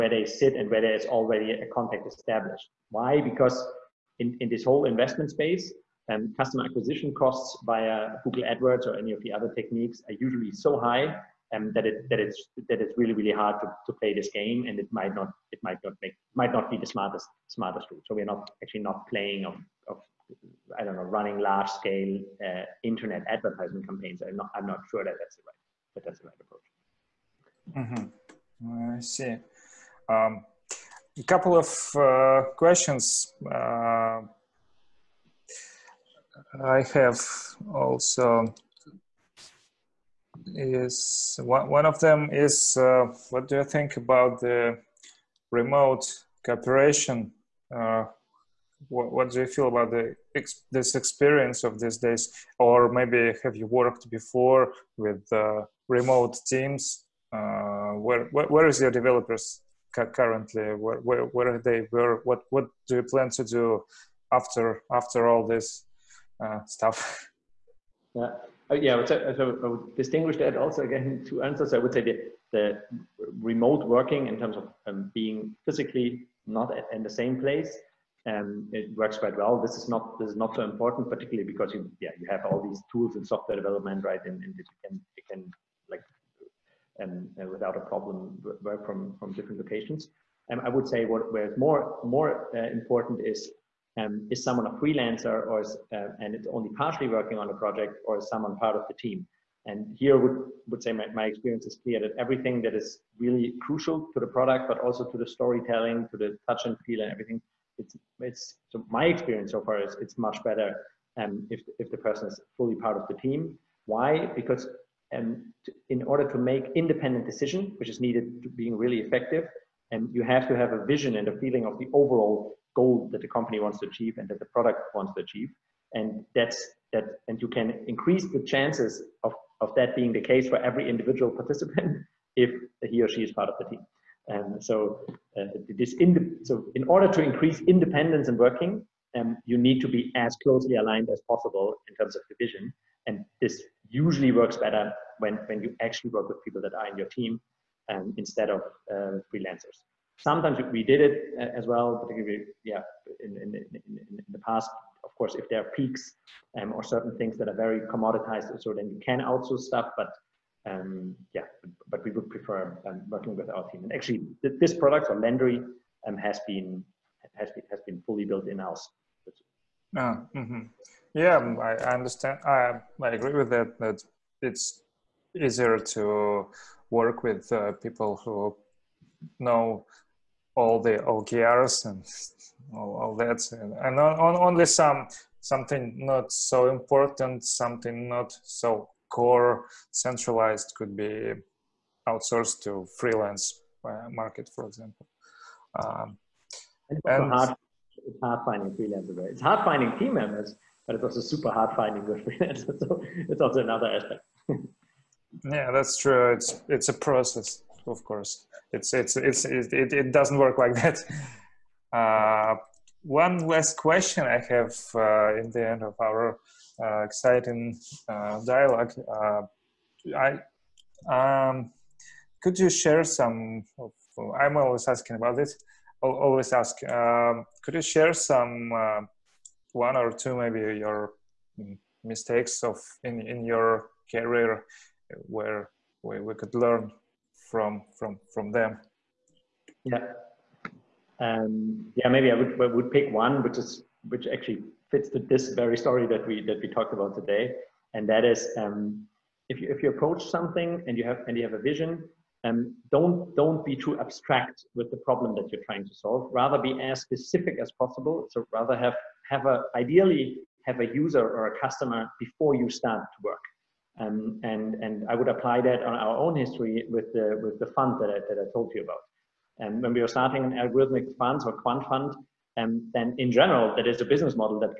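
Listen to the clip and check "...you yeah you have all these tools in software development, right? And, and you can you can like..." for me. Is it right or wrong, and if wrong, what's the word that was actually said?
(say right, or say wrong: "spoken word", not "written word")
right.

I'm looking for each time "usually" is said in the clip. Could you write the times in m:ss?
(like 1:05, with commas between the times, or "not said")
0:10, 2:23.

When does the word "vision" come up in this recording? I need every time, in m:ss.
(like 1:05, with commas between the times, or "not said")
2:00, 2:22, 4:11.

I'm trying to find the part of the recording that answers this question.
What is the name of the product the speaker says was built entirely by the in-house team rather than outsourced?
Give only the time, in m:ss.
2:45.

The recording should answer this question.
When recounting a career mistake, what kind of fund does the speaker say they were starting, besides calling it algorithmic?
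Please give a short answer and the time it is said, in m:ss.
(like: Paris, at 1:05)
quant fund, at 4:31.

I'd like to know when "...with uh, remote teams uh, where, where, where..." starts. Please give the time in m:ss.
0:54.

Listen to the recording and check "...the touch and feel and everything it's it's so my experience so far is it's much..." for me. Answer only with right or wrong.
right.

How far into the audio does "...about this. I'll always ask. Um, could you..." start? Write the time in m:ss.
3:45.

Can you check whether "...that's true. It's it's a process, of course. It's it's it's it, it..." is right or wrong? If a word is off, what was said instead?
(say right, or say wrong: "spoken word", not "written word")
right.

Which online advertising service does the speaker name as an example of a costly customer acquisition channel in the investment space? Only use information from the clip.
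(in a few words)
Google AdWords.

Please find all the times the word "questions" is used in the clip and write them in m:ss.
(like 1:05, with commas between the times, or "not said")
0:32, 3:33.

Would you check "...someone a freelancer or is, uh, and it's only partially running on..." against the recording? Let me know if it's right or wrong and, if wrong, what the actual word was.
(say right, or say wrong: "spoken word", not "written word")
wrong: "working", not "running".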